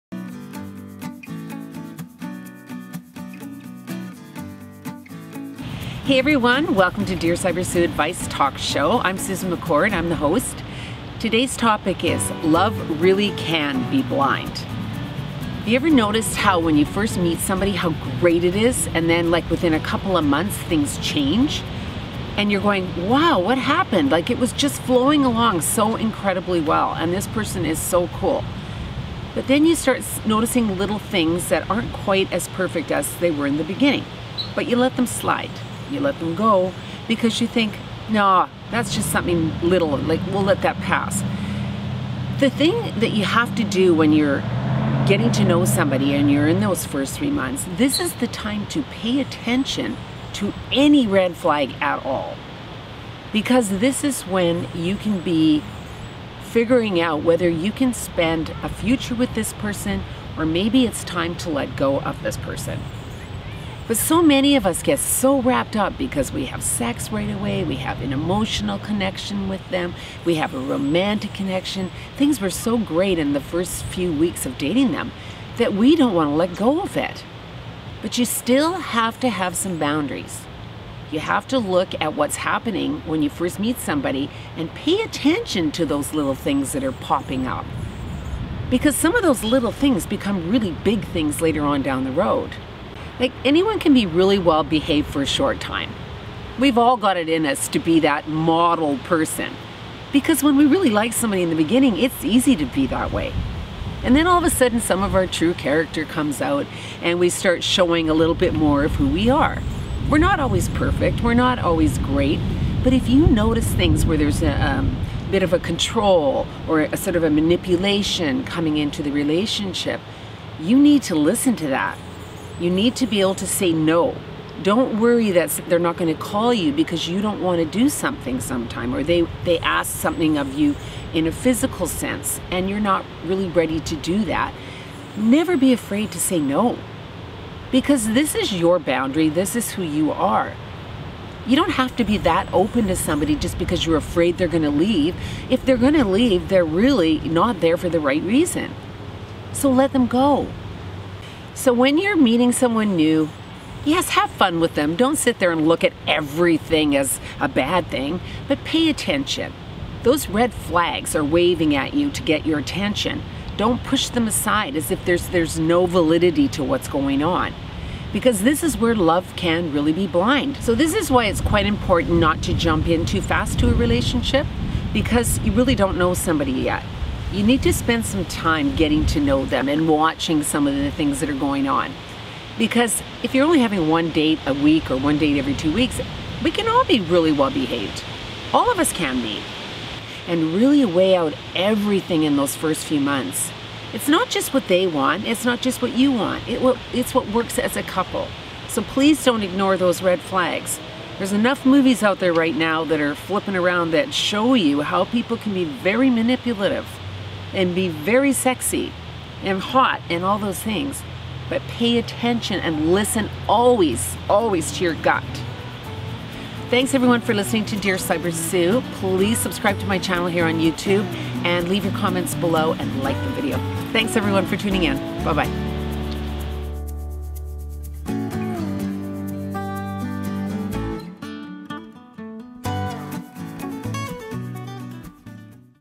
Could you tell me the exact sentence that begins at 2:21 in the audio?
You don't have to be that open to somebody just because you're afraid they're going to leave.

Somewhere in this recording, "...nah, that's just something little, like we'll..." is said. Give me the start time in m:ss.
0:38.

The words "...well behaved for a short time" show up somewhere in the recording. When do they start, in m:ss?
1:34.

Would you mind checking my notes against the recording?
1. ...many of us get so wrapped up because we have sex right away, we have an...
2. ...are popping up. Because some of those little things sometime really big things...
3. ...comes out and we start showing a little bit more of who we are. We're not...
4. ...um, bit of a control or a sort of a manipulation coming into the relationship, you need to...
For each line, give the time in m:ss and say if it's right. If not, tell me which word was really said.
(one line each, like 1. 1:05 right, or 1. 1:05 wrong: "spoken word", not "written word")
1. 1:04 right
2. 1:26 wrong: "become", not "sometime"
3. 1:46 right
4. 1:54 right.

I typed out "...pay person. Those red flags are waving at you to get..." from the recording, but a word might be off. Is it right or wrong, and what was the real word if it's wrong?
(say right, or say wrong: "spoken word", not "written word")
wrong: "attention", not "person".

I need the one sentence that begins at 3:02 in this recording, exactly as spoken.
Because if you're only having one date a week or one date every two weeks, we can all be really well behaved.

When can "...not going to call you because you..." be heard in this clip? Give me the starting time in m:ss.
2:05.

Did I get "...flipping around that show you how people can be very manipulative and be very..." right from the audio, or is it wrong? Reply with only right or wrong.
right.